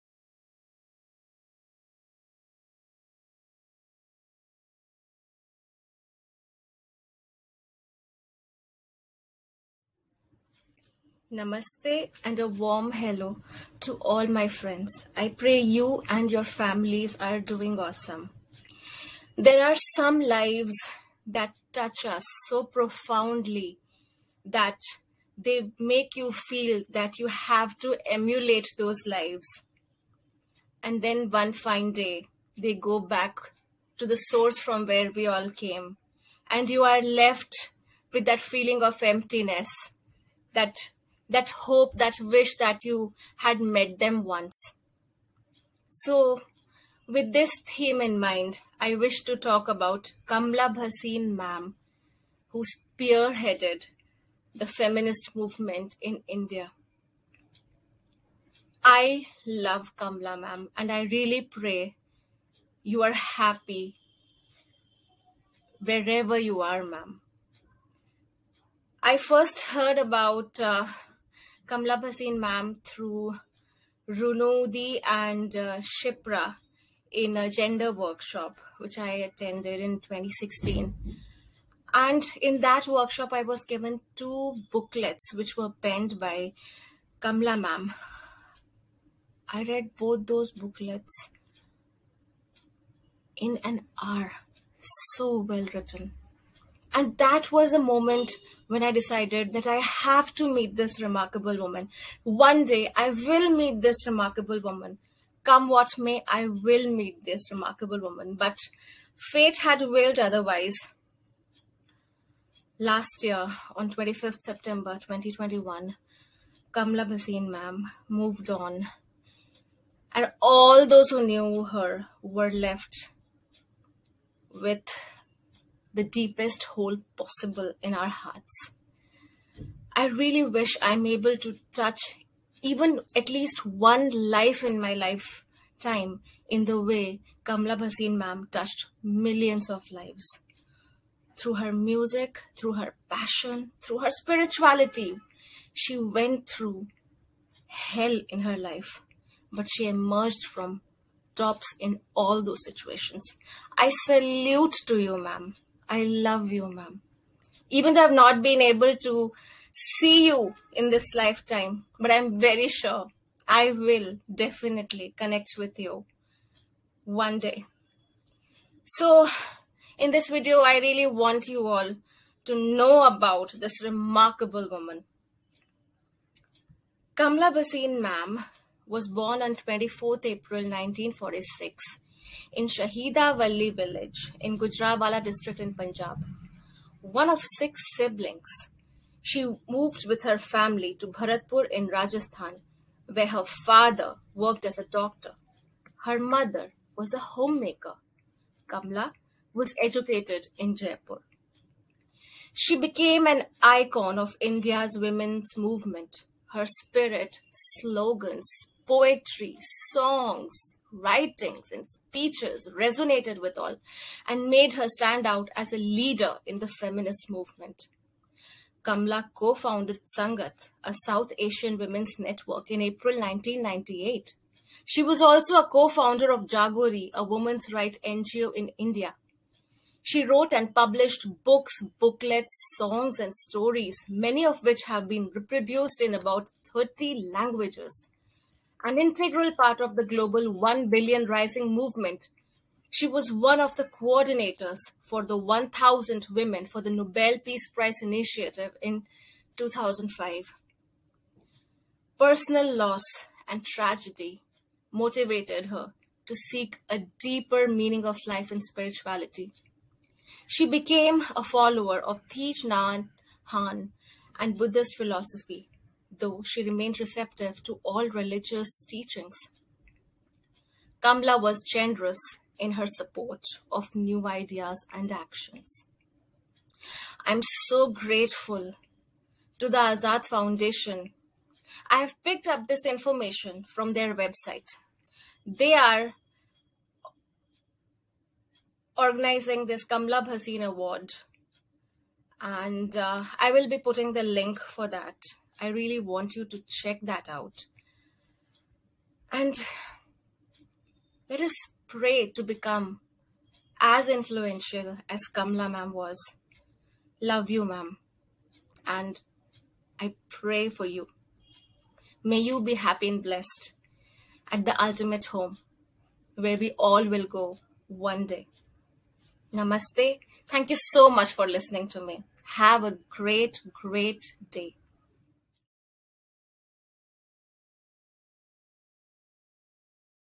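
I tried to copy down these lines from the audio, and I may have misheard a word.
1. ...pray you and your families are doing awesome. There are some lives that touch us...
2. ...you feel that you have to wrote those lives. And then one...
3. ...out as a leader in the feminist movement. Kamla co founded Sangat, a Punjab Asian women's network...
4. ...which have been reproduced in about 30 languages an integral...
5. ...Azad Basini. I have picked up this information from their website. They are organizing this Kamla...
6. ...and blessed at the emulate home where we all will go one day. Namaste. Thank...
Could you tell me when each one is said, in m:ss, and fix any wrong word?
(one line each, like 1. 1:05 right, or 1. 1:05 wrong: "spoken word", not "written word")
1. 0:15 right
2. 0:26 wrong: "emulate", not "wrote"
3. 3:35 wrong: "South", not "Punjab"
4. 3:54 right
5. 4:39 wrong: "Foundation", not "Basini"
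6. 5:13 wrong: "ultimate", not "emulate".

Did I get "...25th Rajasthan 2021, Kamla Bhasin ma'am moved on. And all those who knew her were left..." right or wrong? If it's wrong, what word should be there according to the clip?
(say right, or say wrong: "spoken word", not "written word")
wrong: "September", not "Rajasthan".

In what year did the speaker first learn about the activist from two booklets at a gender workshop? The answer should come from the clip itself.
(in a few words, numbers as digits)
2016.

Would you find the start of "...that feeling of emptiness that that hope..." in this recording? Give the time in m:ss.
0:38.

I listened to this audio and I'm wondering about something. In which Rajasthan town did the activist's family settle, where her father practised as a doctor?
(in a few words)
Bharatpur.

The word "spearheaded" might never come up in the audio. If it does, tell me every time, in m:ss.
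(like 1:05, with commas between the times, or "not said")
0:52.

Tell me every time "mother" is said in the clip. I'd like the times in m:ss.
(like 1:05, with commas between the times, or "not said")
3:16.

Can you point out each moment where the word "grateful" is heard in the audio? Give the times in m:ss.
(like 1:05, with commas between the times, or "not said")
4:37.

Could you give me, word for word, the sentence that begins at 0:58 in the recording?
I love Kamla Ma'am, and I really pray you are happy wherever you are, Ma'am.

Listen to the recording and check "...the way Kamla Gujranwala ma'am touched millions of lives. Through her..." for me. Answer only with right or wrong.
wrong.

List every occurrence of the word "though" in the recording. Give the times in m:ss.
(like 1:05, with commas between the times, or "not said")
2:37, 4:26.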